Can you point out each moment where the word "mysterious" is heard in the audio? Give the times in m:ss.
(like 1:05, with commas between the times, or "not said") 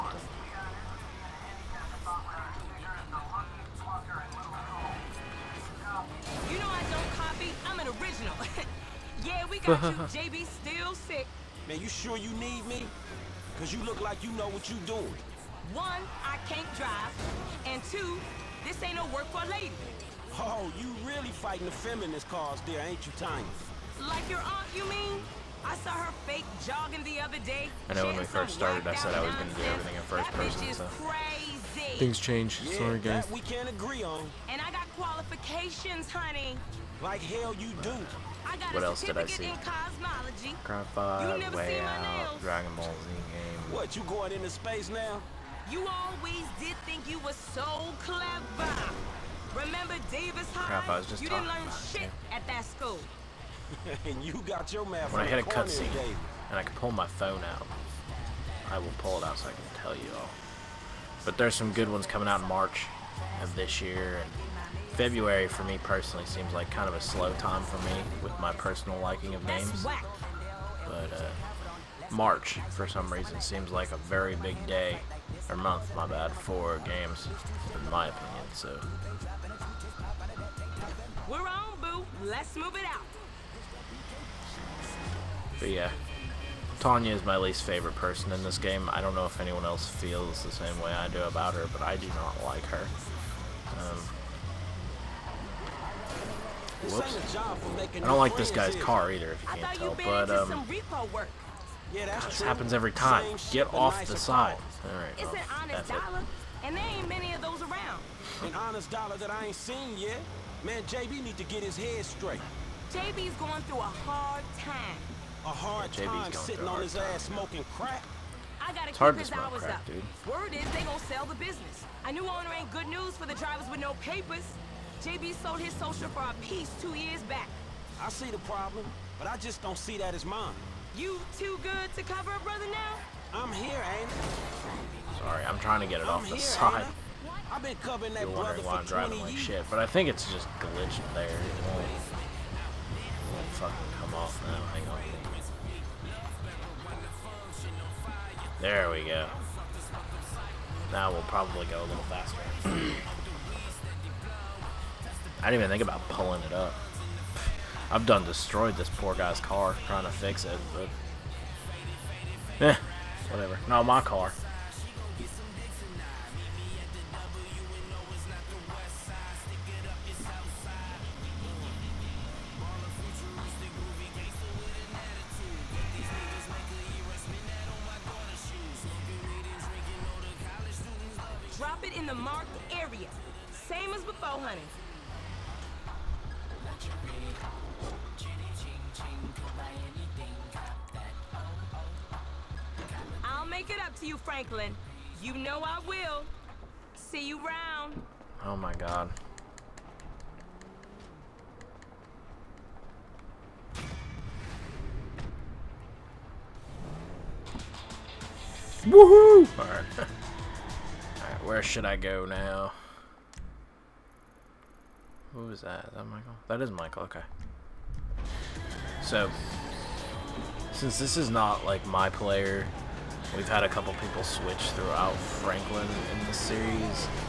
not said.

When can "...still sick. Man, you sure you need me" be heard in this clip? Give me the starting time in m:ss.
0:10.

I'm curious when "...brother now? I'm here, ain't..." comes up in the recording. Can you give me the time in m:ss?
2:12.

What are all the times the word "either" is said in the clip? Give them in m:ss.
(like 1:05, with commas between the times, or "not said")
1:39.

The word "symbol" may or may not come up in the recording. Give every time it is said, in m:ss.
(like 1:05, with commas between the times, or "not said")
not said.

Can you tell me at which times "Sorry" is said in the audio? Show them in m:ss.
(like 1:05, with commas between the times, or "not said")
0:32, 2:15.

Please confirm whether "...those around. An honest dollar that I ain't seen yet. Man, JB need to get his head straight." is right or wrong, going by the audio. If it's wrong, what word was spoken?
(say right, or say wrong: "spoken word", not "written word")
right.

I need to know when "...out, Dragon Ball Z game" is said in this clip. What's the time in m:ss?
0:41.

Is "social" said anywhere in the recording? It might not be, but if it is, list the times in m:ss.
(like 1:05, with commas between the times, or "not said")
2:05.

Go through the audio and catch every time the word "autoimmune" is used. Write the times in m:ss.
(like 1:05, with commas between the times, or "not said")
not said.